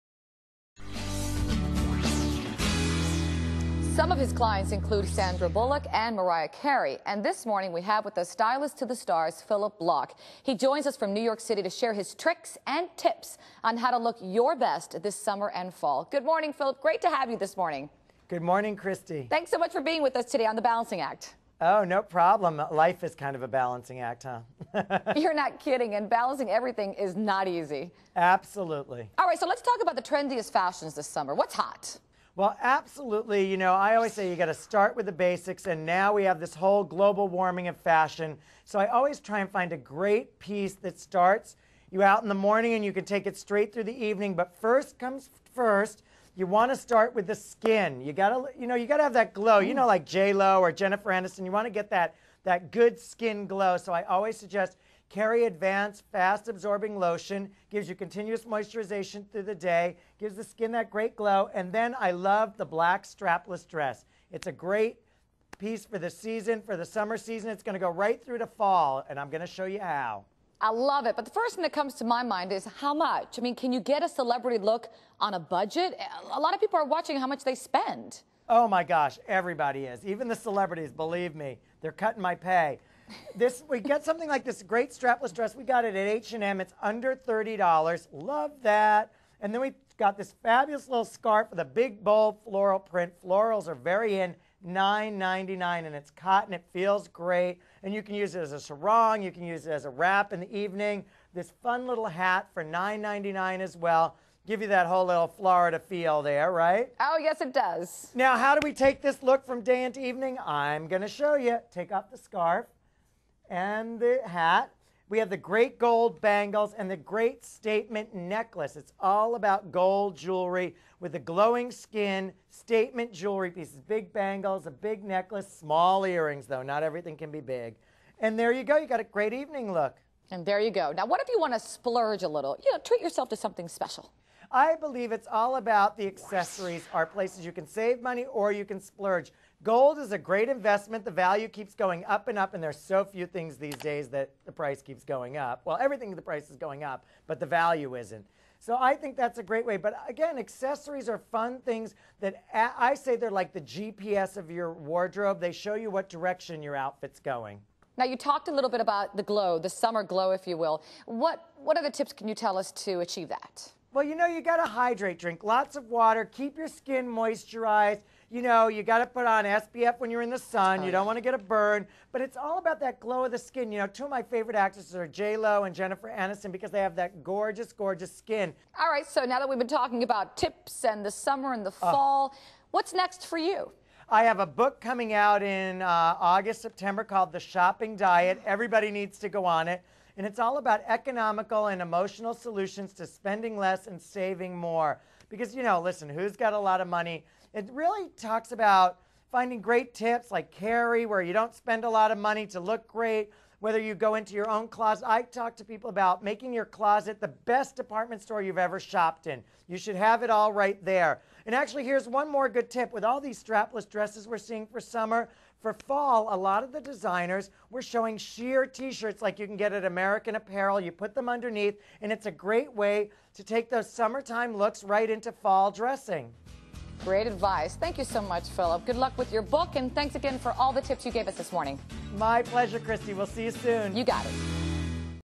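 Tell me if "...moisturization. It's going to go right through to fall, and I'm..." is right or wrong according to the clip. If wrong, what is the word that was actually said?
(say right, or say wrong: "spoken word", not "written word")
wrong: "season", not "moisturization".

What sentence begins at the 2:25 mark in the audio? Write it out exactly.
Well, everything the price is going up, but the value isn't.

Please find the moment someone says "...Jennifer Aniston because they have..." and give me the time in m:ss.
2:55.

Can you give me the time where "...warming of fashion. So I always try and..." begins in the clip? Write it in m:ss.
0:37.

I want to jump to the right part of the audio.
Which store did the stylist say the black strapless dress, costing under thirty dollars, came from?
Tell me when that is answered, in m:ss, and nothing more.
1:26.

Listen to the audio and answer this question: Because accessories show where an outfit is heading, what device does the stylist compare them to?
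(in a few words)
GPS.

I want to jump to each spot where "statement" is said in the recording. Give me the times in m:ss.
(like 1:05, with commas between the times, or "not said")
1:57, 2:02.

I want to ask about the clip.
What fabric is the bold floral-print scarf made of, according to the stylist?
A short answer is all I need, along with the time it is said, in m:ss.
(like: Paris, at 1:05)
Cotton, at 1:36.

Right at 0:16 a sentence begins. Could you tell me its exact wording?
Great to have you this morning.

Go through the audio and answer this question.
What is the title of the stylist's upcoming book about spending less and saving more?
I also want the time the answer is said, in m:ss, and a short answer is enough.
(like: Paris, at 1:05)
The Shopping Diet, at 3:07.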